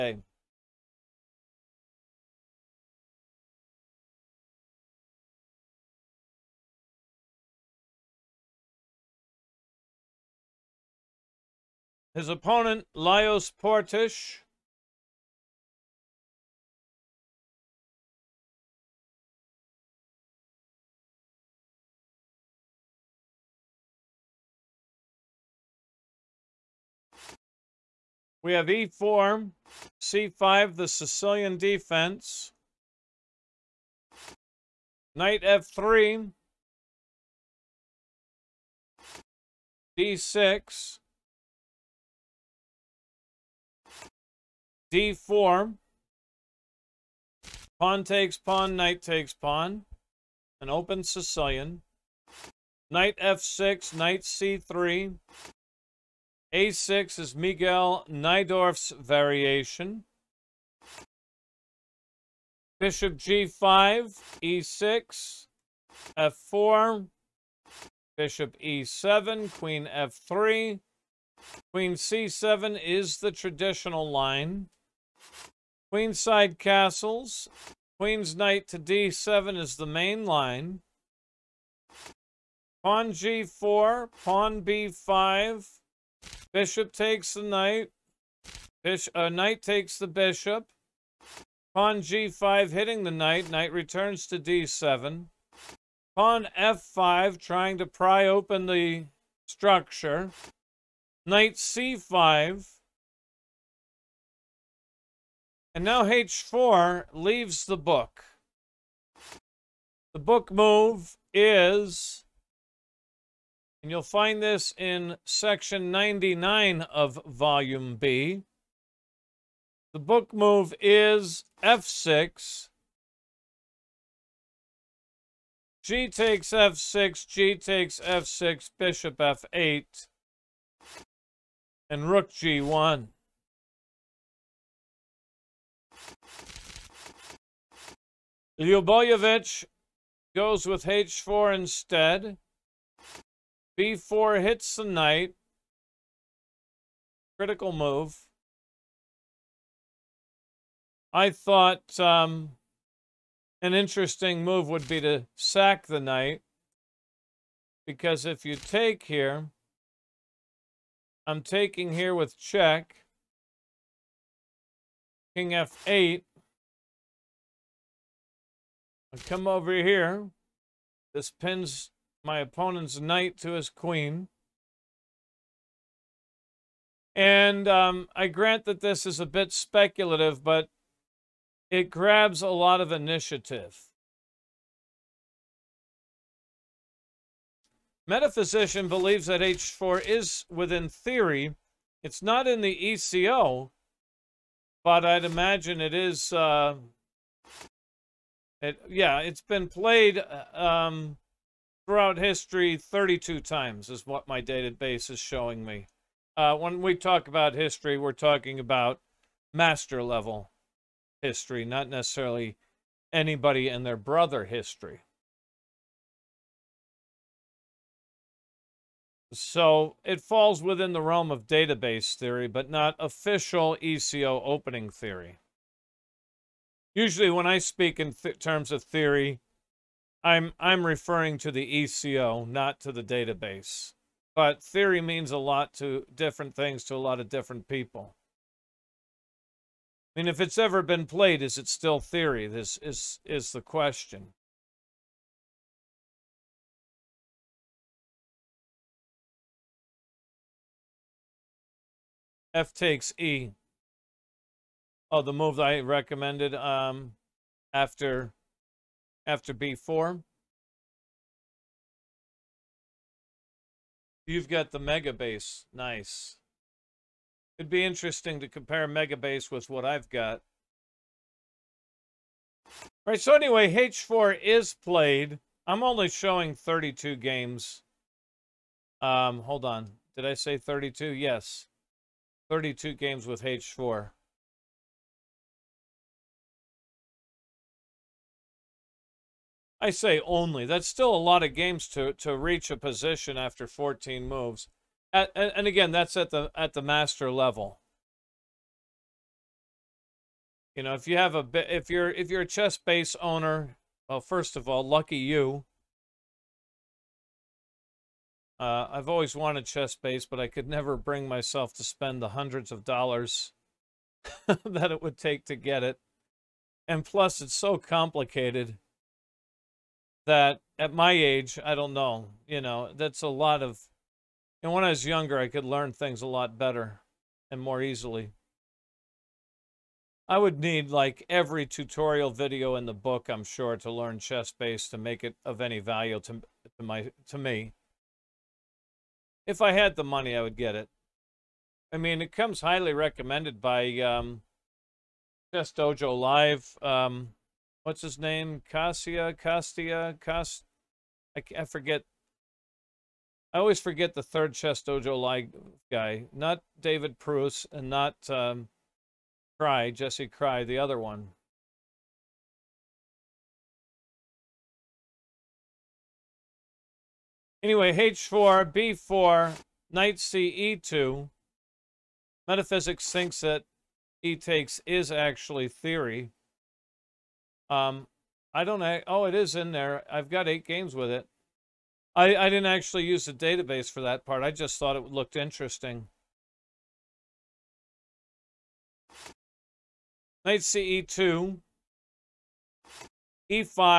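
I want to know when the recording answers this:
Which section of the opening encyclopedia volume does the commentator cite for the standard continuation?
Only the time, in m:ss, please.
1:55.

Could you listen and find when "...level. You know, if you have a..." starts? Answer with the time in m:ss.
4:57.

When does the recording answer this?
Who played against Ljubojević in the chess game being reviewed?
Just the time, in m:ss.
0:12.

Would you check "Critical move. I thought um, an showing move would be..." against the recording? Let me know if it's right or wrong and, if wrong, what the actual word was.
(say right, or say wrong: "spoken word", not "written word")
wrong: "interesting", not "showing".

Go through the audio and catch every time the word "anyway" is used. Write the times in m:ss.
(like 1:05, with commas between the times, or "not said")
4:33, 6:07.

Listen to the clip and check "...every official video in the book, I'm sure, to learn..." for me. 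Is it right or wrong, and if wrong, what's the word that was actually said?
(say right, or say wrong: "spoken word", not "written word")
wrong: "tutorial", not "official".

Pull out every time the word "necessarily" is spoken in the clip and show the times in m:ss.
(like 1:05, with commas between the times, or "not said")
3:31.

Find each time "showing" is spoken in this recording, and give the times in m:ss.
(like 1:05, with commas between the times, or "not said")
3:25, 4:36.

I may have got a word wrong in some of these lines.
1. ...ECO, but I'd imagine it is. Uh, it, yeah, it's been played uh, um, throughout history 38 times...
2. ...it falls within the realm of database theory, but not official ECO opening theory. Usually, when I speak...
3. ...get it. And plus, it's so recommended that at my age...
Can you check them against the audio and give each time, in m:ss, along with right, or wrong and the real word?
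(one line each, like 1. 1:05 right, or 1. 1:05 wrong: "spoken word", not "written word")
1. 3:12 wrong: "32", not "38"
2. 3:40 right
3. 5:15 wrong: "complicated", not "recommended".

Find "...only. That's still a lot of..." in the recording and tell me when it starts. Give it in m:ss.
4:50.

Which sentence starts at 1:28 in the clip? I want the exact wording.
Bishop, uh, knight takes the bishop.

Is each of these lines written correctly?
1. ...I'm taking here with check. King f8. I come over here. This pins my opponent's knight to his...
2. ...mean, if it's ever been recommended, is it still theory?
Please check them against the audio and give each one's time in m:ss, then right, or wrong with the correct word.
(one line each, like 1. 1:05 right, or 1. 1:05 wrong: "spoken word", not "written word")
1. 2:41 right
2. 4:00 wrong: "played", not "recommended".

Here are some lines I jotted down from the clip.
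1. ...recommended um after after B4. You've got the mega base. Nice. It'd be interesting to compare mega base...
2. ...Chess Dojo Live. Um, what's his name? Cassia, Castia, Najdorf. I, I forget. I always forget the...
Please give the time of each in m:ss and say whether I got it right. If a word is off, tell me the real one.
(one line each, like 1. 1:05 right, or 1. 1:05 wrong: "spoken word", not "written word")
1. 4:15 right
2. 5:45 wrong: "Cast", not "Najdorf".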